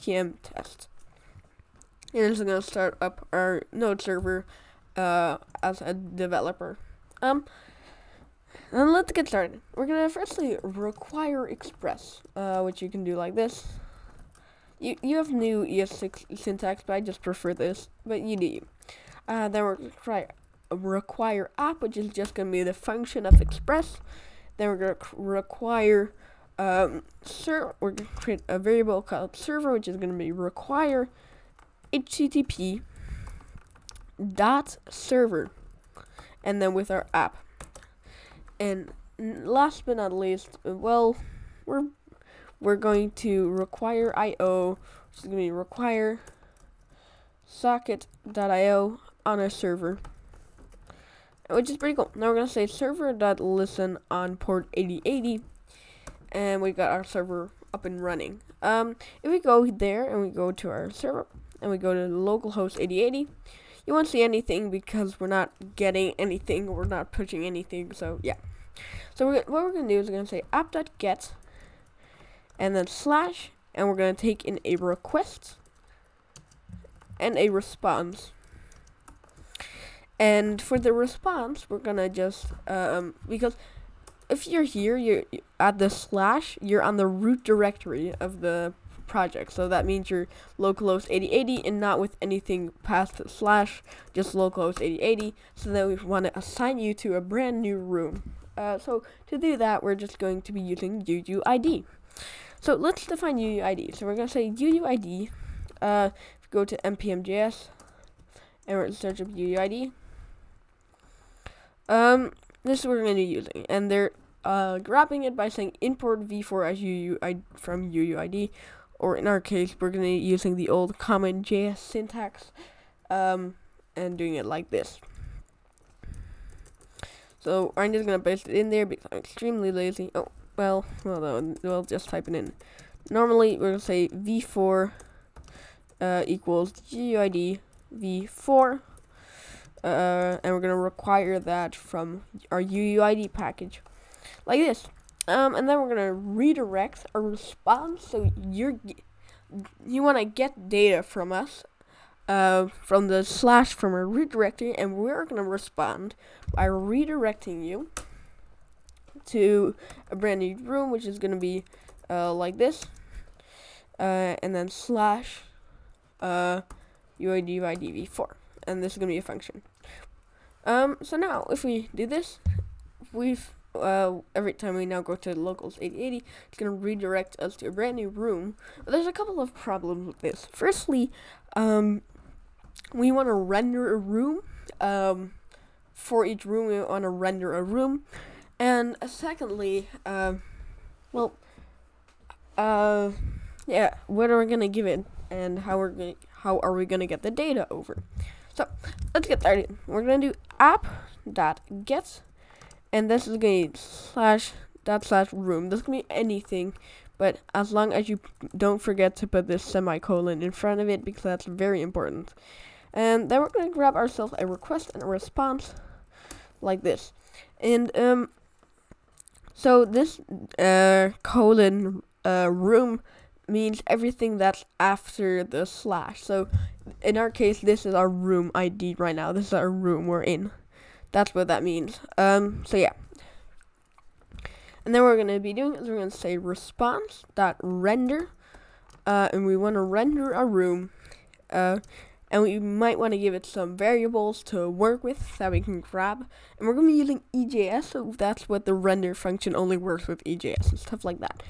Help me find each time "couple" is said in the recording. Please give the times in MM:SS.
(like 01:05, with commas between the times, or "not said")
02:59.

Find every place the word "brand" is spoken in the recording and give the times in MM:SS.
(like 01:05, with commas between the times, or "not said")
01:37, 02:40, 02:57.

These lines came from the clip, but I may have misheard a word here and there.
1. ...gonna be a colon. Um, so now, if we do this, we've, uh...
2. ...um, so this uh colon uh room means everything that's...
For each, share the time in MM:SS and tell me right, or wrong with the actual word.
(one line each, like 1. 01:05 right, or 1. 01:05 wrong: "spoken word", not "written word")
1. 02:48 wrong: "function", not "colon"
2. 03:37 right.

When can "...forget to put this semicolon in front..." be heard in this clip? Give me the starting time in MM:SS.
03:28.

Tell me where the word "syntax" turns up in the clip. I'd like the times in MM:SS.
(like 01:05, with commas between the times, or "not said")
00:16, 02:01.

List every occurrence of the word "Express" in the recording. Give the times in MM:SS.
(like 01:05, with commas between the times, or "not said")
00:11, 00:23.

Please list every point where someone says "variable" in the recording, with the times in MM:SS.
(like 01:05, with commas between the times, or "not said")
00:28, 04:03.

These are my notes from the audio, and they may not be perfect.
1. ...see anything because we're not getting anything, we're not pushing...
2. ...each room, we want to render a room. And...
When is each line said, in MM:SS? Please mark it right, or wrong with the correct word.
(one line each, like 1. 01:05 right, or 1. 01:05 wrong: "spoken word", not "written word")
1. 01:04 right
2. 03:06 right.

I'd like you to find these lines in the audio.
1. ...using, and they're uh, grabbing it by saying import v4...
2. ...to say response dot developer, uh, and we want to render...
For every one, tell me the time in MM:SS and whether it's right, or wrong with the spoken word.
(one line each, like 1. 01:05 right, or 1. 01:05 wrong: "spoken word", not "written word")
1. 01:53 right
2. 03:56 wrong: "render", not "developer".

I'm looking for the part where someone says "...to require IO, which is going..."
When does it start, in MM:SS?
00:43.